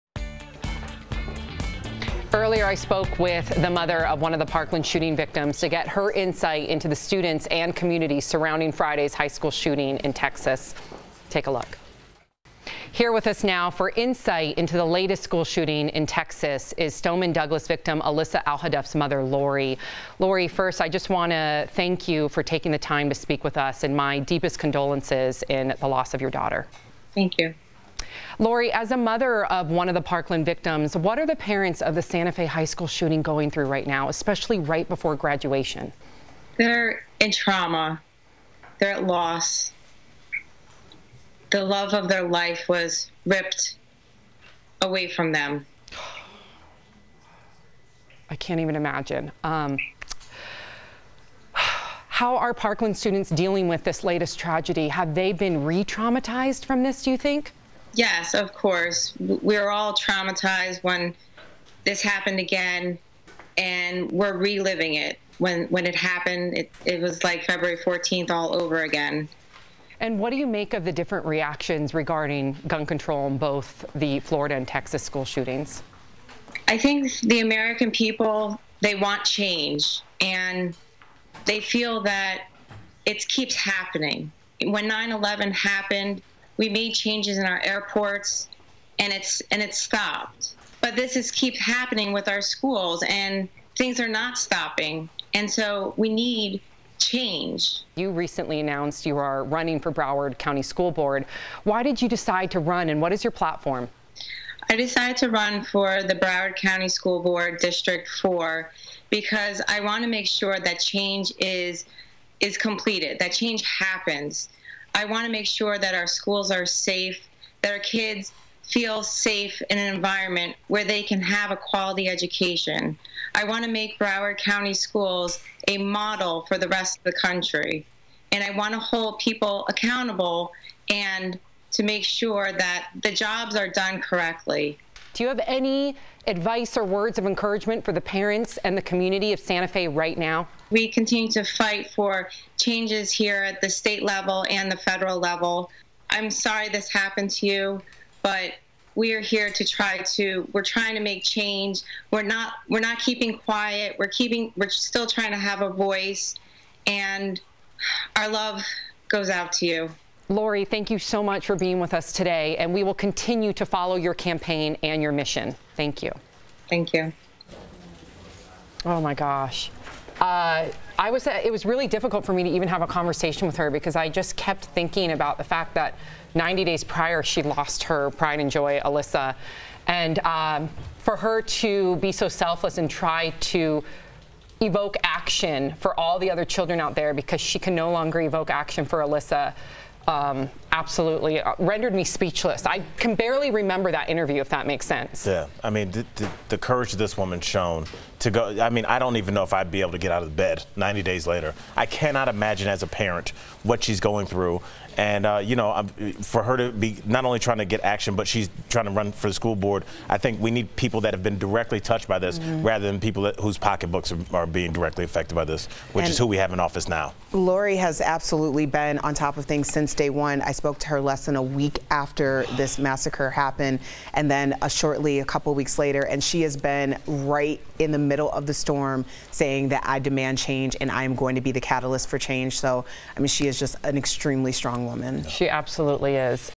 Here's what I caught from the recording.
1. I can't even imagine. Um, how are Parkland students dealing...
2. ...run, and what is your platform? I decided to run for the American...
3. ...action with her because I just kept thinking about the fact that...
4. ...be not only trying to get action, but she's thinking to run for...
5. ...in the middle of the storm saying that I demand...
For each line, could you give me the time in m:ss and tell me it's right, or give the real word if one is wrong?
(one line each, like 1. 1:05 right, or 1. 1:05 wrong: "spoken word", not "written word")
1. 0:48 right
2. 1:42 wrong: "Broward", not "American"
3. 2:52 wrong: "conversation", not "action"
4. 3:26 wrong: "trying", not "thinking"
5. 3:47 right.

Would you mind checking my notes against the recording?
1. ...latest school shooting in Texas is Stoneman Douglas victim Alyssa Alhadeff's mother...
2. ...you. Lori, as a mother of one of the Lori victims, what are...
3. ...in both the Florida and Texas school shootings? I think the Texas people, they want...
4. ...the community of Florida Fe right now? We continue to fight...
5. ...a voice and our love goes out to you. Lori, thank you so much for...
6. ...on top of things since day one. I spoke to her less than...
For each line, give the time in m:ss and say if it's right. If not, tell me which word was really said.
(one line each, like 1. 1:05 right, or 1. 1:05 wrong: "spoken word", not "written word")
1. 0:14 right
2. 0:27 wrong: "Parkland", not "Lori"
3. 1:13 wrong: "American", not "Texas"
4. 2:18 wrong: "Santa", not "Florida"
5. 2:35 right
6. 3:39 right.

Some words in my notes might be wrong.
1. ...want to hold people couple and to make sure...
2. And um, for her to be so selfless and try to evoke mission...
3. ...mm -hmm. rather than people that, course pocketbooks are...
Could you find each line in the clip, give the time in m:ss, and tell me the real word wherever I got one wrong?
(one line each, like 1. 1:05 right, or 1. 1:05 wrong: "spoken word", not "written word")
1. 2:08 wrong: "accountable", not "couple"
2. 2:59 wrong: "action", not "mission"
3. 3:32 wrong: "whose", not "course".